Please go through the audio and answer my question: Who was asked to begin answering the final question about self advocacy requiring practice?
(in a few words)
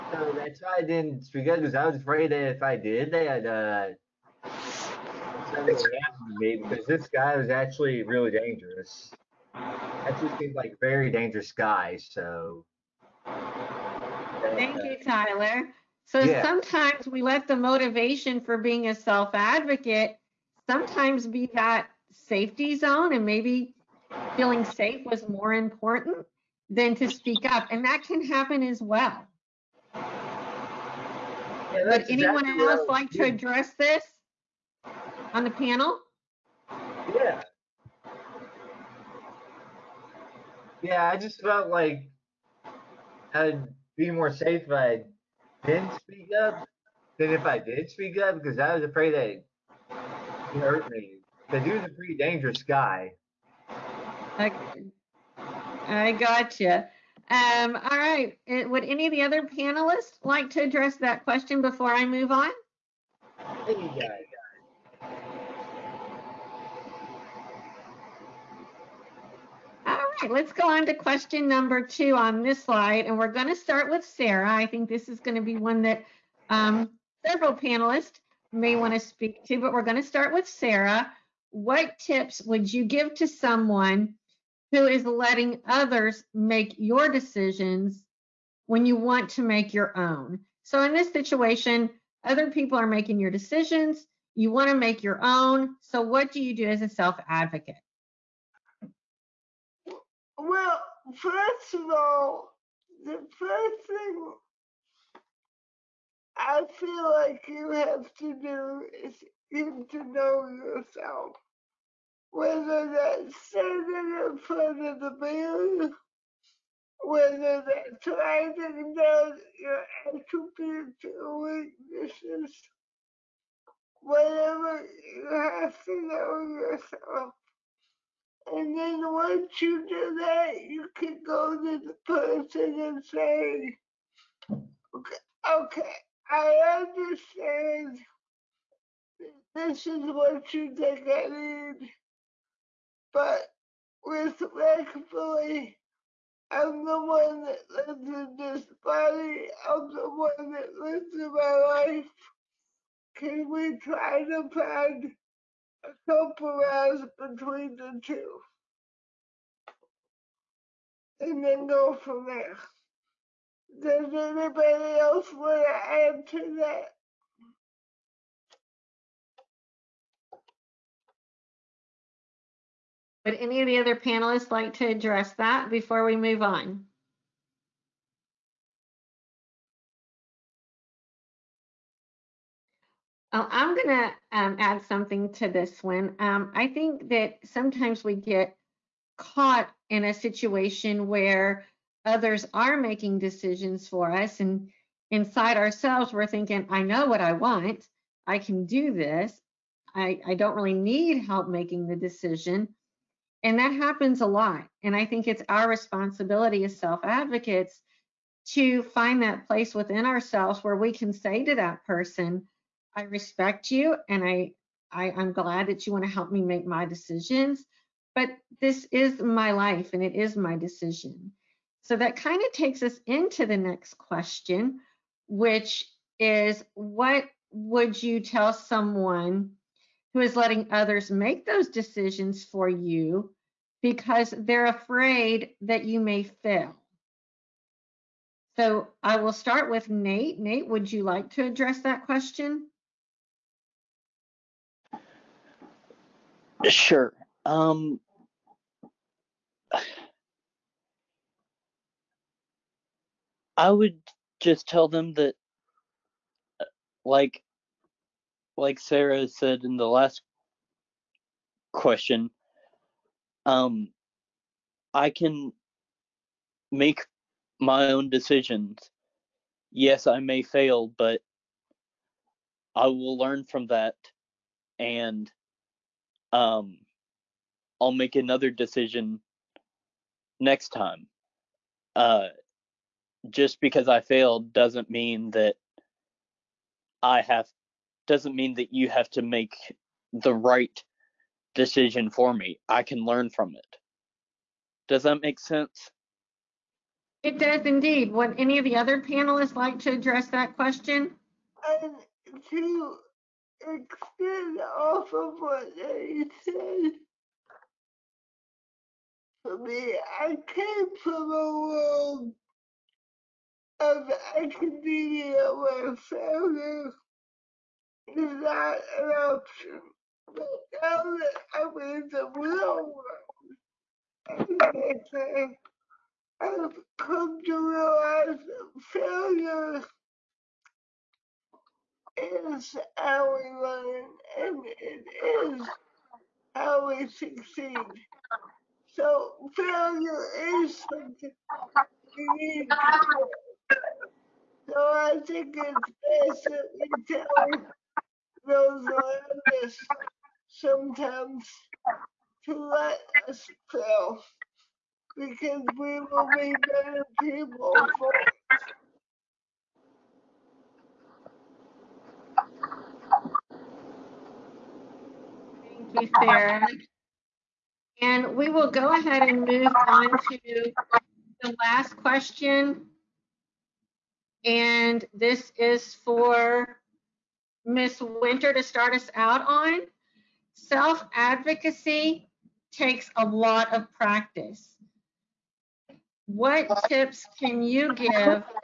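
Ms. Winter.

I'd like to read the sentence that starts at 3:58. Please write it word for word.
So I will start with Nate.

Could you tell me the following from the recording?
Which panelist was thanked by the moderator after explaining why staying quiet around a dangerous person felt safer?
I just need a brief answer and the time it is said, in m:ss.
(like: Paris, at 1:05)
Tyler, at 0:15.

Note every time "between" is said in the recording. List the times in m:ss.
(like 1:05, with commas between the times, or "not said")
2:37.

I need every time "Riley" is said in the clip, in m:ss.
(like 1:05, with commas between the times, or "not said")
not said.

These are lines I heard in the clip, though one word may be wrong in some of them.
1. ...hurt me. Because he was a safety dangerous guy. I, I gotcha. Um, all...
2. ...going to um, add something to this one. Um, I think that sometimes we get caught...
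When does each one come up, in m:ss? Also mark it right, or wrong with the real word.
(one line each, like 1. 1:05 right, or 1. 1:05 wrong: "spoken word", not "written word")
1. 0:50 wrong: "pretty", not "safety"
2. 3:03 right.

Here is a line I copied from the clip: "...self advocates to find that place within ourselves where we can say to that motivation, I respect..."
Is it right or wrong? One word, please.
wrong.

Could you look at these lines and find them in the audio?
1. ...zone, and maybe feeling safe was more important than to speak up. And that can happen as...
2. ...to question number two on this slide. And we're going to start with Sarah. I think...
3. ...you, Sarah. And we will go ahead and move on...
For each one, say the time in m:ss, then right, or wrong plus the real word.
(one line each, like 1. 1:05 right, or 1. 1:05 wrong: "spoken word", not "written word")
1. 0:22 right
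2. 1:10 right
3. 6:06 right.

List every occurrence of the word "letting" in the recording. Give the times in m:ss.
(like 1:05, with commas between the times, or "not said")
1:25, 3:50.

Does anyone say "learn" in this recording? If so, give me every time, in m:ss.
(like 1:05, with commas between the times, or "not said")
4:33, 4:53, 5:33.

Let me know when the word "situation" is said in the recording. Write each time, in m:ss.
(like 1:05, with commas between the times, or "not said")
1:31, 3:10.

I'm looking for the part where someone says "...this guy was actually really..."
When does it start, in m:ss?
0:06.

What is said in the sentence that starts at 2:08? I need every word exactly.
And then once you do that, you can go to the person and say, okay, okay I understand.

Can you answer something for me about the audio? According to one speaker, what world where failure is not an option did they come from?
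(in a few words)
Academia.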